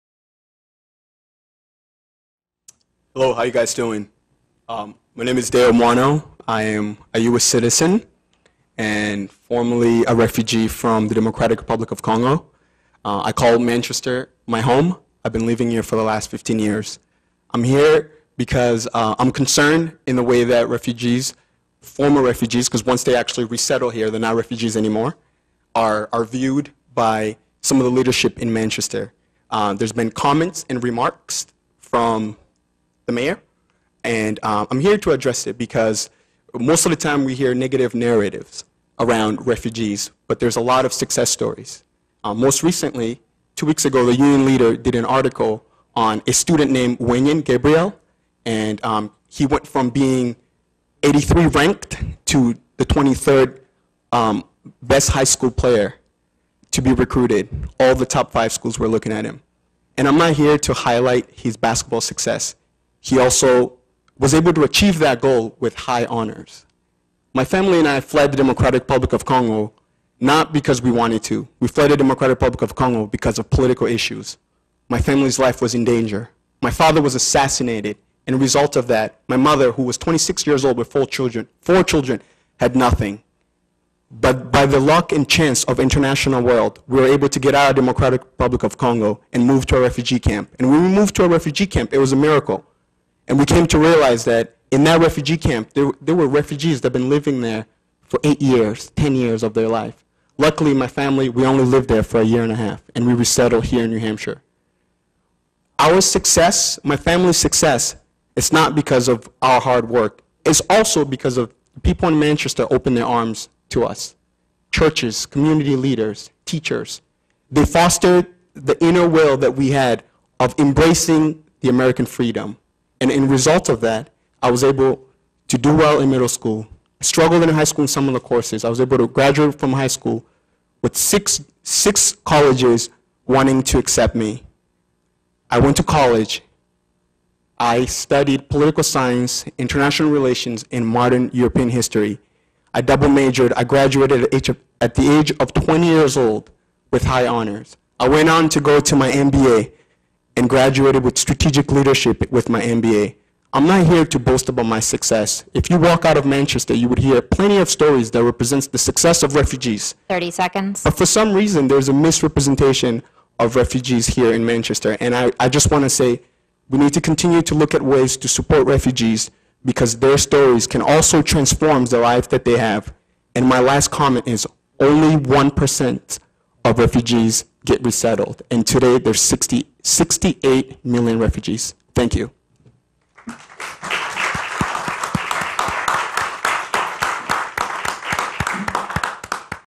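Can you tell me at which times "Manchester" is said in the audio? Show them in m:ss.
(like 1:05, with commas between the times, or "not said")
0:13, 0:28, 1:52, 2:36, 2:44.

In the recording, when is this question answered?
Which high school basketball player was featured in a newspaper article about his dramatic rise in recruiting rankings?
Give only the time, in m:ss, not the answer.
0:46.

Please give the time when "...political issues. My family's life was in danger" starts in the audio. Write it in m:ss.
1:13.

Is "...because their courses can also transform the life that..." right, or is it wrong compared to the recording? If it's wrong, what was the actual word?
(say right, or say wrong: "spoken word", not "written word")
wrong: "stories", not "courses".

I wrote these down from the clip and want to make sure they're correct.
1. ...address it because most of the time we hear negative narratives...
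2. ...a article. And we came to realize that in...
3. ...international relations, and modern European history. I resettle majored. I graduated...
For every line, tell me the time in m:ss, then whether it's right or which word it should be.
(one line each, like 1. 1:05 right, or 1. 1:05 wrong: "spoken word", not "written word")
1. 0:35 right
2. 1:32 wrong: "miracle", not "article"
3. 2:19 wrong: "double", not "resettle".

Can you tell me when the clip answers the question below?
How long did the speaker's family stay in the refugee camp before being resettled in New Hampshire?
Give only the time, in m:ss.
1:42.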